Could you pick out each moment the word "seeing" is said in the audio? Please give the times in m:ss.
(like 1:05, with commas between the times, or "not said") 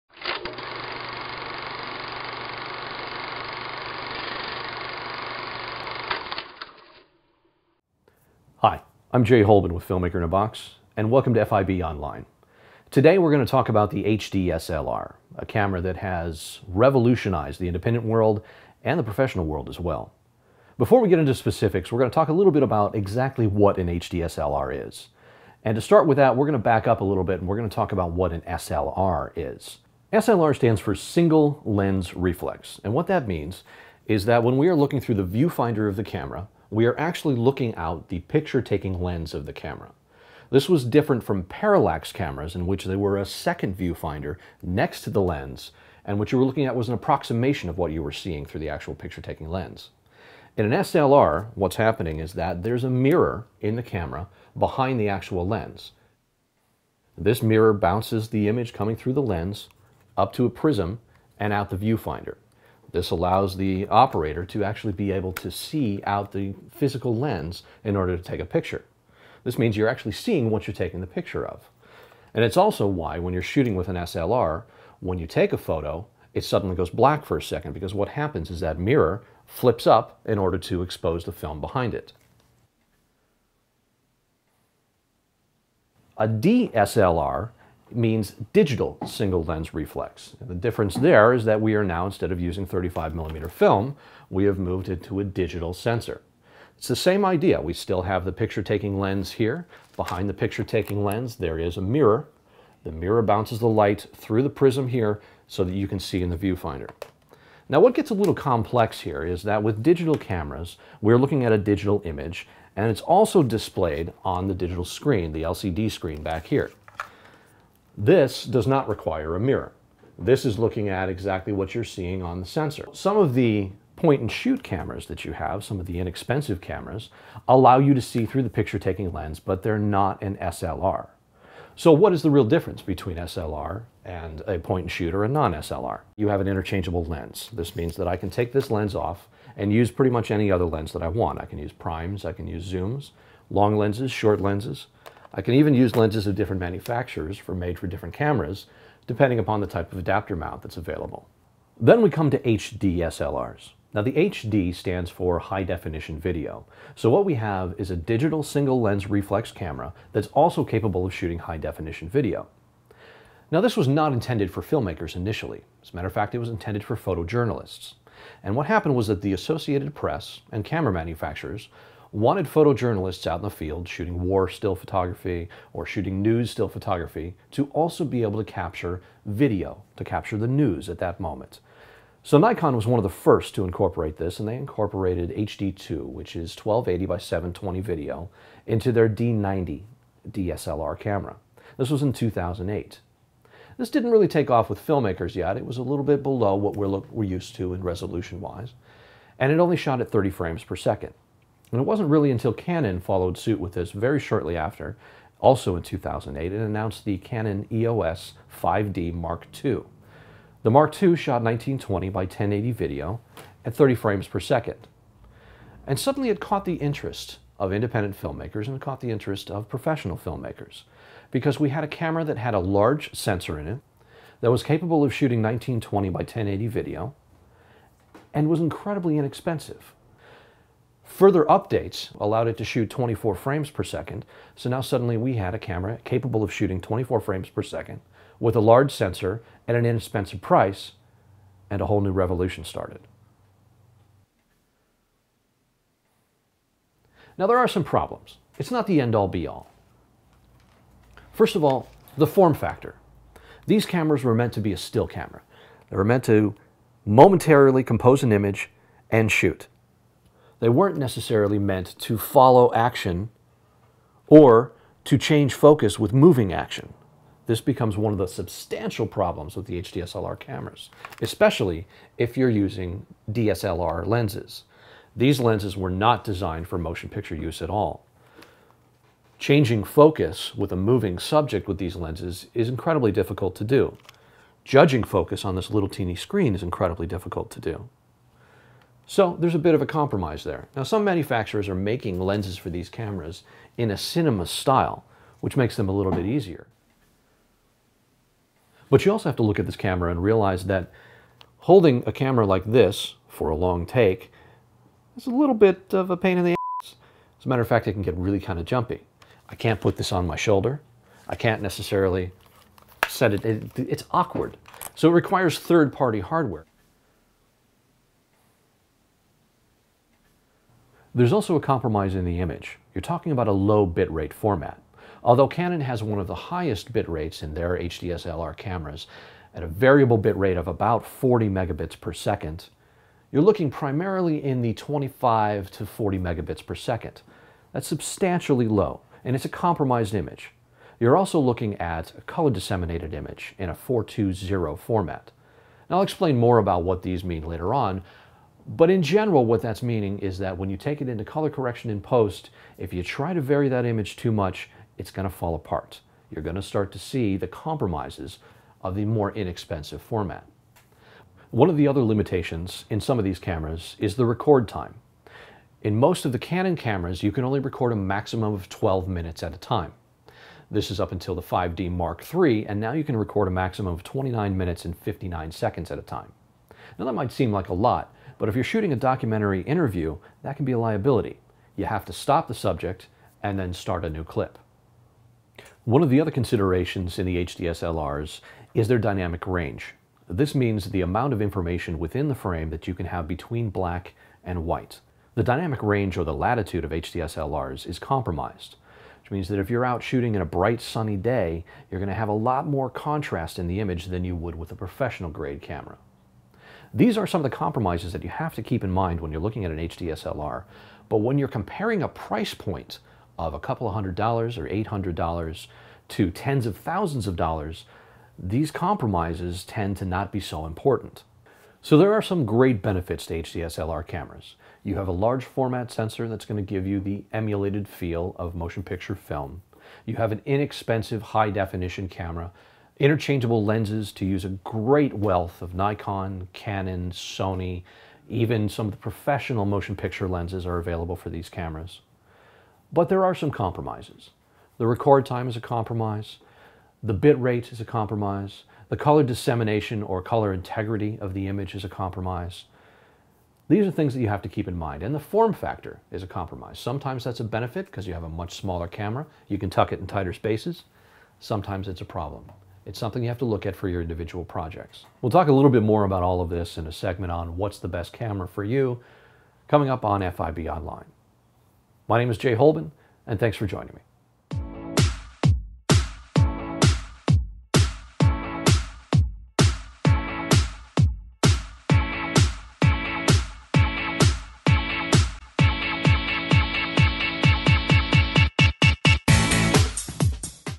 0:48, 1:10, 2:01.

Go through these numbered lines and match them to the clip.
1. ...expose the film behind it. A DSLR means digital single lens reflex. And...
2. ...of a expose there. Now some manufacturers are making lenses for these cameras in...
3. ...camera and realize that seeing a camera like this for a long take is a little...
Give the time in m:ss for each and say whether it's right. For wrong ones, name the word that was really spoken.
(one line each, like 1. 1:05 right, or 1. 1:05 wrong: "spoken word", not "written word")
1. 1:20 right
2. 4:49 wrong: "compromise", not "expose"
3. 4:59 wrong: "holding", not "seeing".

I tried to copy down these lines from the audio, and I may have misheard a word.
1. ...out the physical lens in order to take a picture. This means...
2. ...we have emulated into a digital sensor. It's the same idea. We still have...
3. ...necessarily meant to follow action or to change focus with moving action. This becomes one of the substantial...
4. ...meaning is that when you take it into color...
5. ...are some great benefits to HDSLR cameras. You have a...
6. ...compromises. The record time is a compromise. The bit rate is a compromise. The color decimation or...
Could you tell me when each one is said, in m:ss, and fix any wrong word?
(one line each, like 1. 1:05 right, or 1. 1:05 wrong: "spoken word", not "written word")
1. 1:06 right
2. 1:34 wrong: "moved", not "emulated"
3. 4:20 right
4. 5:49 right
5. 7:02 right
6. 7:23 right.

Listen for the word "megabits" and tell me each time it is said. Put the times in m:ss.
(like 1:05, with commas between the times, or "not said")
5:31, 5:36.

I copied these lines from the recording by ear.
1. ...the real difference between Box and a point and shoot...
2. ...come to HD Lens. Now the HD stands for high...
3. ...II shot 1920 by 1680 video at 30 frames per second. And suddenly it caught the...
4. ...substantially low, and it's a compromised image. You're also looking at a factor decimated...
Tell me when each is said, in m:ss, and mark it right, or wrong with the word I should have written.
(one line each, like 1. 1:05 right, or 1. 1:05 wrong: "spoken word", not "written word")
1. 2:12 wrong: "SLR", not "Box"
2. 2:32 wrong: "SLRs", not "Lens"
3. 3:31 wrong: "1080", not "1680"
4. 5:37 wrong: "color", not "factor".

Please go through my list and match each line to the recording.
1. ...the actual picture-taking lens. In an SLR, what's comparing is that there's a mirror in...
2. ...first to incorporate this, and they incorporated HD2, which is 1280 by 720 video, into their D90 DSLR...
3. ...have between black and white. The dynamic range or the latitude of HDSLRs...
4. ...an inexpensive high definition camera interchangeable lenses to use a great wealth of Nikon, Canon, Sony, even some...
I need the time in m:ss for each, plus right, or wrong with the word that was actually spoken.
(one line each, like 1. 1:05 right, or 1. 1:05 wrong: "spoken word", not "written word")
1. 0:48 wrong: "happening", not "comparing"
2. 3:03 right
3. 6:33 right
4. 7:10 right.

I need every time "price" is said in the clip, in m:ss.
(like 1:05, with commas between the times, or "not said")
4:00, 6:52.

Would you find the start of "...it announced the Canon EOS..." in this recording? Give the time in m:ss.
3:26.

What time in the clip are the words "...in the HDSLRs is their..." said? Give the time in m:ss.
6:27.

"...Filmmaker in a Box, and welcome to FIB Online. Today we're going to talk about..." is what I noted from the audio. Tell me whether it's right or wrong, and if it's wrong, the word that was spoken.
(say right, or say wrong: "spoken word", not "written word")
right.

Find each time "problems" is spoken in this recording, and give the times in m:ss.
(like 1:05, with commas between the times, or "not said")
4:07, 4:29, 7:42.